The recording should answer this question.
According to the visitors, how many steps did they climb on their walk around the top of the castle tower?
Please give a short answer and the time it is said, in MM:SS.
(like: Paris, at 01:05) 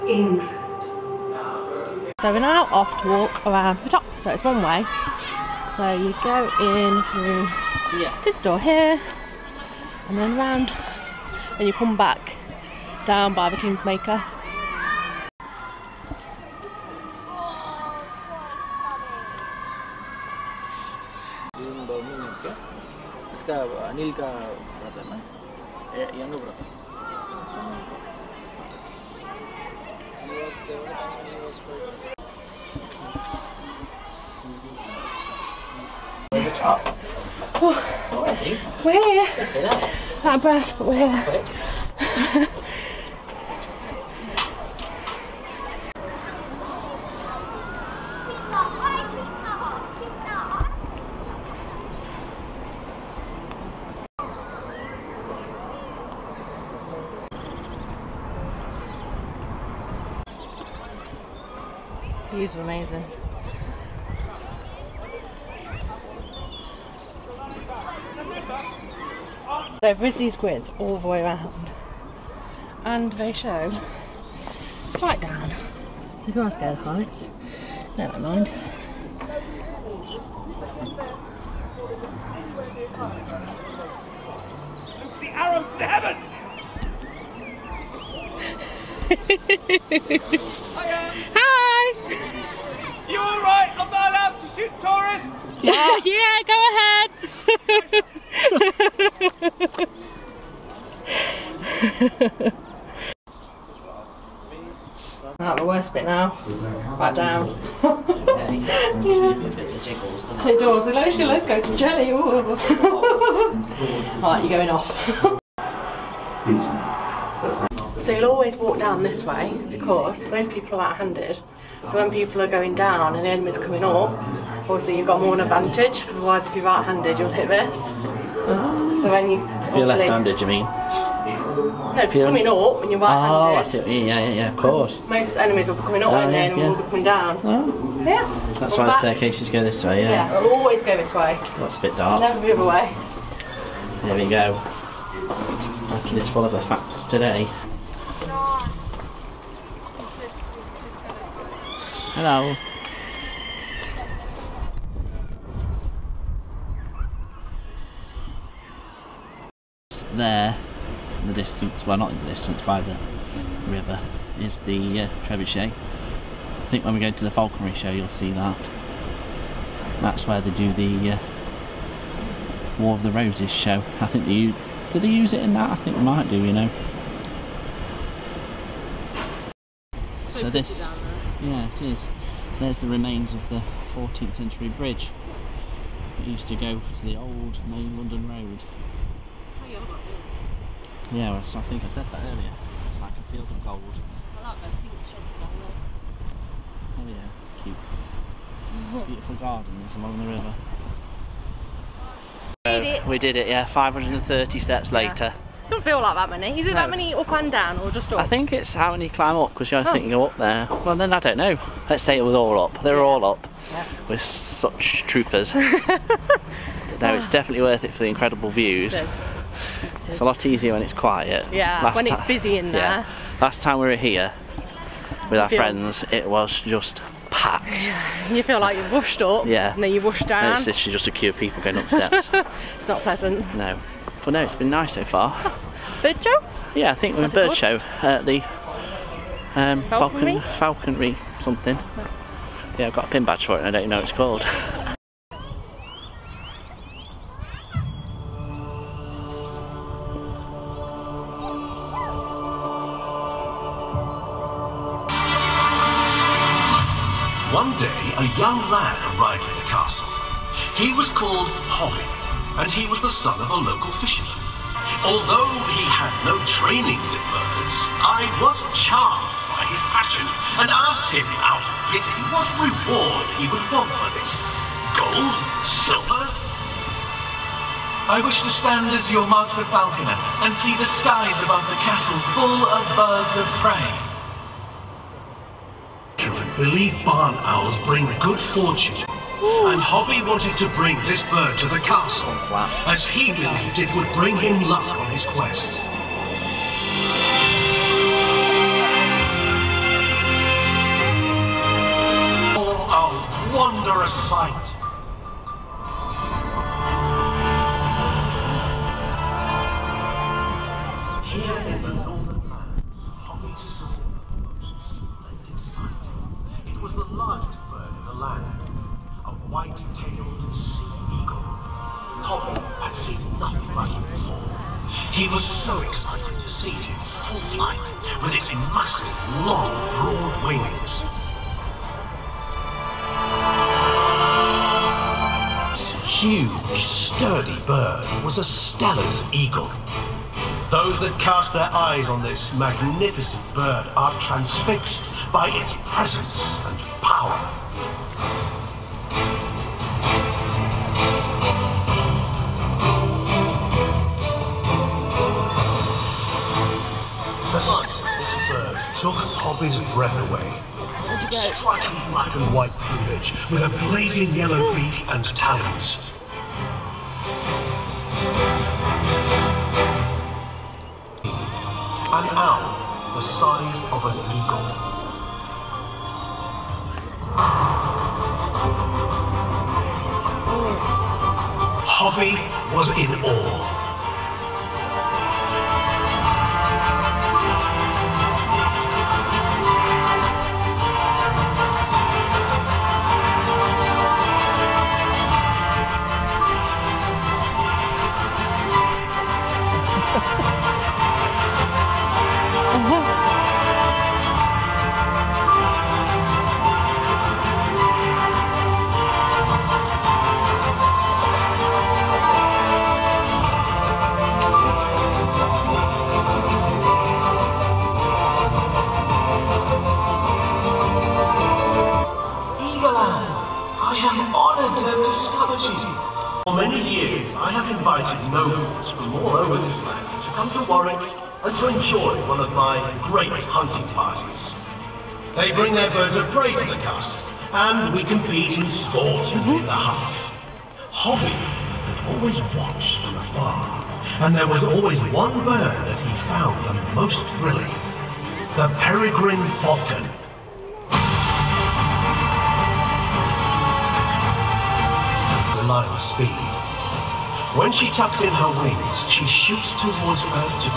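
530, at 03:23.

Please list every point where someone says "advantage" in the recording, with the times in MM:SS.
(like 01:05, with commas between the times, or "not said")
02:05.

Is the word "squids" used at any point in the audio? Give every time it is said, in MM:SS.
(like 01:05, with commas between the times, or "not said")
01:10.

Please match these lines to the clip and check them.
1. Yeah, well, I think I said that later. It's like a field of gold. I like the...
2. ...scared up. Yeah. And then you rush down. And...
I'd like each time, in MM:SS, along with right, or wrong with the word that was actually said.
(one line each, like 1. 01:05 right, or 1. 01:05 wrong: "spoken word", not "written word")
1. 03:11 wrong: "earlier", not "later"
2. 03:48 wrong: "rushed", not "scared".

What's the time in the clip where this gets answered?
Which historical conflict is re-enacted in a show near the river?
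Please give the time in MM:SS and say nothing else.
02:52.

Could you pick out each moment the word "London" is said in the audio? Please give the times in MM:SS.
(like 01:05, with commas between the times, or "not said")
03:07.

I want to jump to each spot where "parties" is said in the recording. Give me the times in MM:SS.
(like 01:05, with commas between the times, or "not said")
07:13.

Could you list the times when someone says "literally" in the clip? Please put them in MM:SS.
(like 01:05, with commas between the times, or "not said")
03:50.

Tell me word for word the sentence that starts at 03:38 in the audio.
It it's a lot easier when it's quiet.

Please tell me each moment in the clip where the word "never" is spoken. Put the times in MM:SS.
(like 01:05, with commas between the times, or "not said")
01:17, 02:22.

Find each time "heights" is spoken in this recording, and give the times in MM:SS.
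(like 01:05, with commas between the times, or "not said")
01:16.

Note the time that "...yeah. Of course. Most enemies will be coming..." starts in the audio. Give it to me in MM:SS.
02:14.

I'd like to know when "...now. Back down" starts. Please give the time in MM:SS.
01:46.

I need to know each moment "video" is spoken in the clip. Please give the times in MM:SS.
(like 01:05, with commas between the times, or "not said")
not said.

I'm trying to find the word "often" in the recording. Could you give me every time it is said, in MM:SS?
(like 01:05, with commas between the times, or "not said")
not said.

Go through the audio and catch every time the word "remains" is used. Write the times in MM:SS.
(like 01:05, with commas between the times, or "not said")
03:02.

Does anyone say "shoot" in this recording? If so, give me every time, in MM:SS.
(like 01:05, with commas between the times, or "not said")
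01:34, 07:39.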